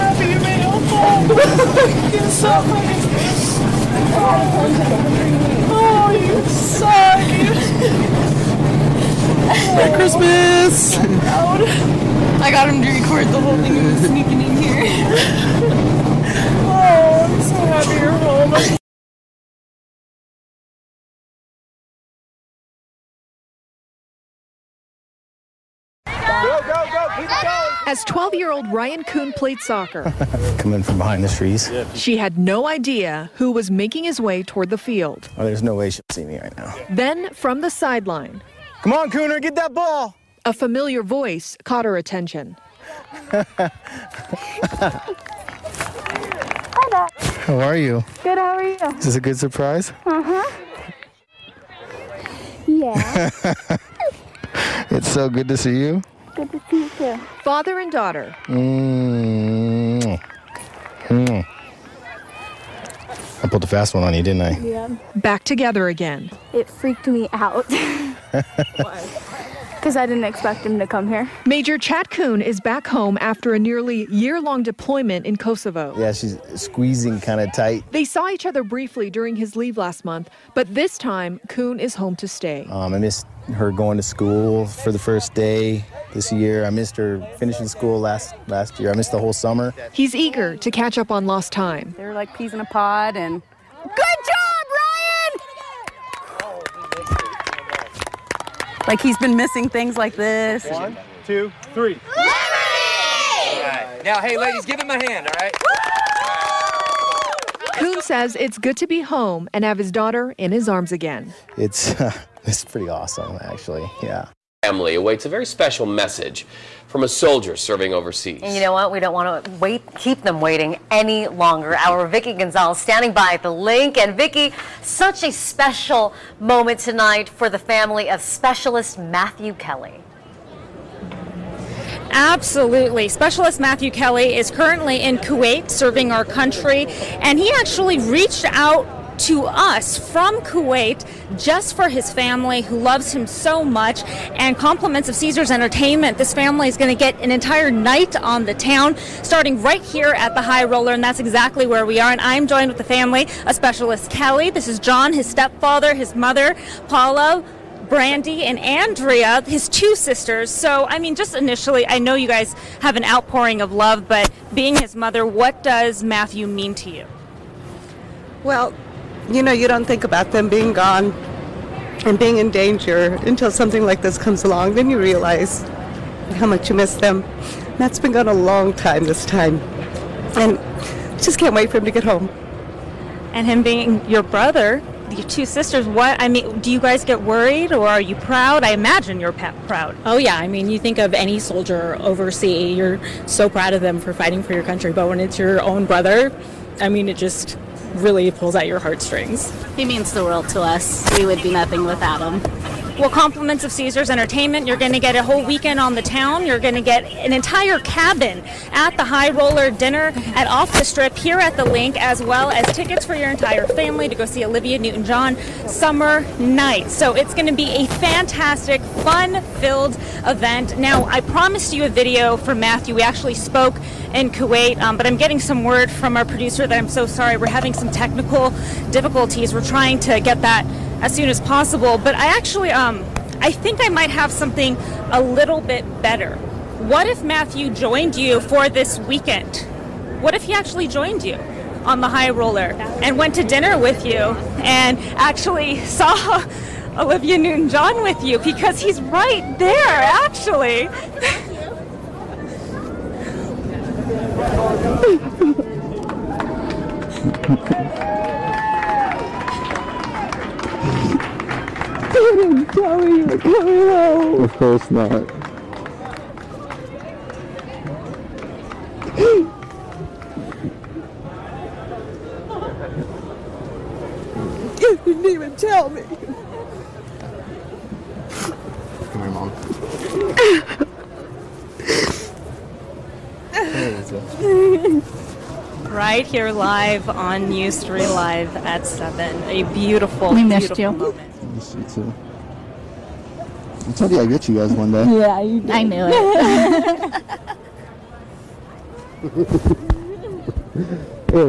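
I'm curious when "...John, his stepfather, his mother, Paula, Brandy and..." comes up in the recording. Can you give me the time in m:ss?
2:34.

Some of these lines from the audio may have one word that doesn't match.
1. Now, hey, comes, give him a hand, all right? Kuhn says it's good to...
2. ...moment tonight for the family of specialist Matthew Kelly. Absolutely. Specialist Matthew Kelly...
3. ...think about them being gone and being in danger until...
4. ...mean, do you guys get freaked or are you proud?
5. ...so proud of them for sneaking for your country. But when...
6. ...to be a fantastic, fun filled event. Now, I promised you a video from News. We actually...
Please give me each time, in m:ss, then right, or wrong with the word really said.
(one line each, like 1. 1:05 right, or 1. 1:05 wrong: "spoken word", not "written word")
1. 1:44 wrong: "ladies", not "comes"
2. 2:06 right
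3. 2:49 right
4. 3:06 wrong: "worried", not "freaked"
5. 3:13 wrong: "fighting", not "sneaking"
6. 3:37 wrong: "Matthew", not "News".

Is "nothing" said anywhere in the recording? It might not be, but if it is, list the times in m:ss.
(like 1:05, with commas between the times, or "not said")
3:21.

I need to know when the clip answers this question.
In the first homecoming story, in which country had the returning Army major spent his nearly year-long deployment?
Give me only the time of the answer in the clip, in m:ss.
1:15.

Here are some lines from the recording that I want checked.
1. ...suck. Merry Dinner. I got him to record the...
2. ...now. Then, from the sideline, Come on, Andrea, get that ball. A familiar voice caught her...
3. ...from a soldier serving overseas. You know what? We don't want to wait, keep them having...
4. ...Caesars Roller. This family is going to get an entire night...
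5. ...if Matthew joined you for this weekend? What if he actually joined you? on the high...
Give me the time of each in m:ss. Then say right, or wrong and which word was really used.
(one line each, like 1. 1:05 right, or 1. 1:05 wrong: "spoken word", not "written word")
1. 0:06 wrong: "Christmas", not "Dinner"
2. 0:36 wrong: "Cooner", not "Andrea"
3. 1:56 wrong: "waiting", not "having"
4. 2:25 wrong: "Entertainment", not "Roller"
5. 3:57 right.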